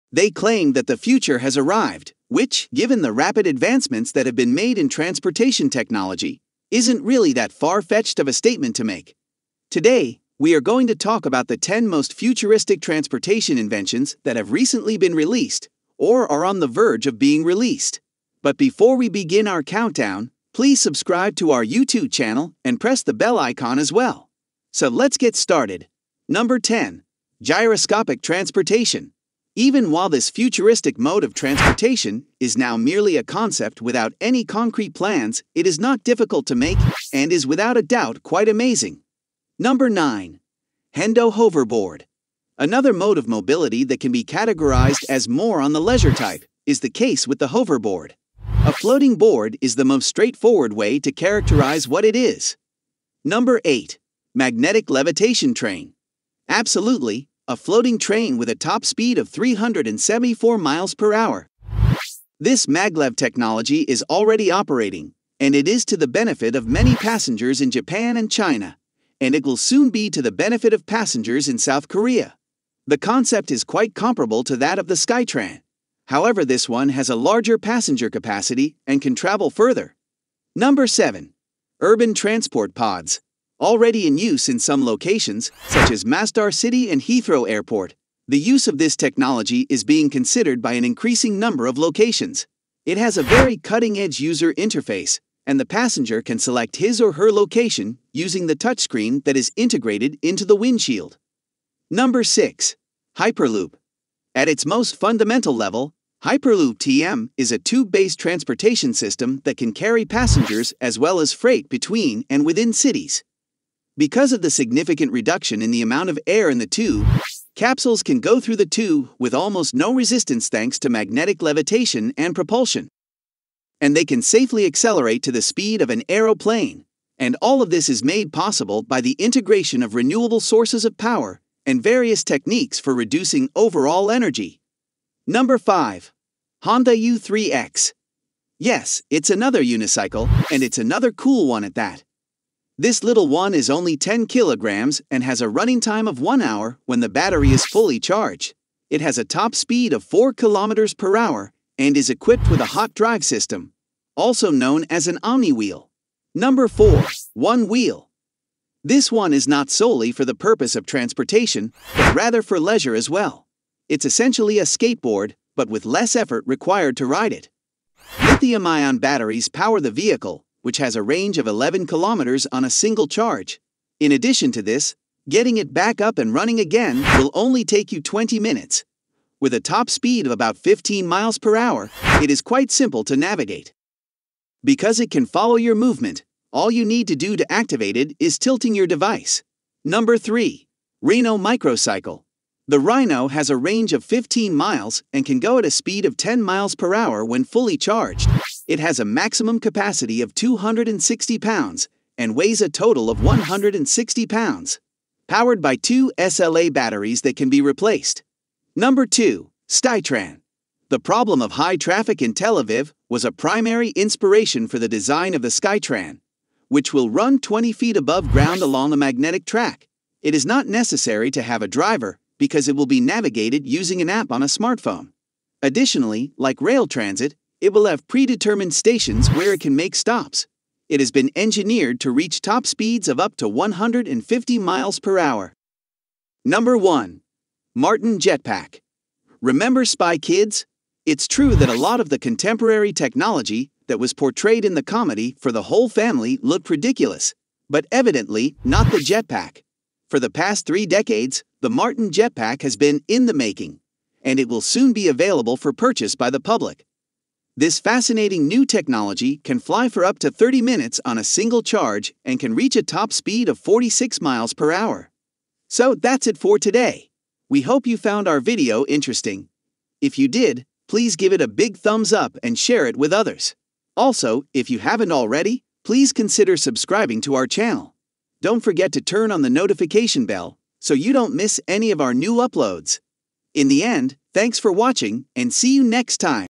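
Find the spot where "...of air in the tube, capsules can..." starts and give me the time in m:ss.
1:56.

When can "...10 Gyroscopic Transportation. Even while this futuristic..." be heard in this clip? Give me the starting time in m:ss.
0:26.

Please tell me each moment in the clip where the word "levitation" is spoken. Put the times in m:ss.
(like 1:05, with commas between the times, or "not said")
0:54, 2:01.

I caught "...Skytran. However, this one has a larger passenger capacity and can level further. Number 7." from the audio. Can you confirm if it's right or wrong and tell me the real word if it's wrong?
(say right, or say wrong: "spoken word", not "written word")
wrong: "travel", not "level".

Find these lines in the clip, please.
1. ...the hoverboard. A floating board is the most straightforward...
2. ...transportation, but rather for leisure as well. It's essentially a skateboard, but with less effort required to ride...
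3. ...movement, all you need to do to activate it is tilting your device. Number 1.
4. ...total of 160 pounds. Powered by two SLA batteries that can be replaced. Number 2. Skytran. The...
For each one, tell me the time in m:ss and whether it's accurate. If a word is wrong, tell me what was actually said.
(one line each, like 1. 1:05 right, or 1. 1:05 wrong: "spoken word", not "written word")
1. 0:47 right
2. 2:40 right
3. 3:05 wrong: "3", not "1"
4. 3:22 right.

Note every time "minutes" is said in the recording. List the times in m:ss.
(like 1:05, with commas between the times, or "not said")
2:58, 4:20.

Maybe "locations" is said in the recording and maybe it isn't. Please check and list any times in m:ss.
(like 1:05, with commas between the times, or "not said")
1:24, 1:31, 1:37.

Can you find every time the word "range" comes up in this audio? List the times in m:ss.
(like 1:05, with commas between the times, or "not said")
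2:51, 3:13.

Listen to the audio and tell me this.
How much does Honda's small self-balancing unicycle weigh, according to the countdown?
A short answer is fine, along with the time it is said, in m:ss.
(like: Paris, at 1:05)
10 kilograms, at 2:23.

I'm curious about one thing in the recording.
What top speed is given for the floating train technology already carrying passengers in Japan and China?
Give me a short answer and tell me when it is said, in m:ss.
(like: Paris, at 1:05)
374 miles per hour, at 0:59.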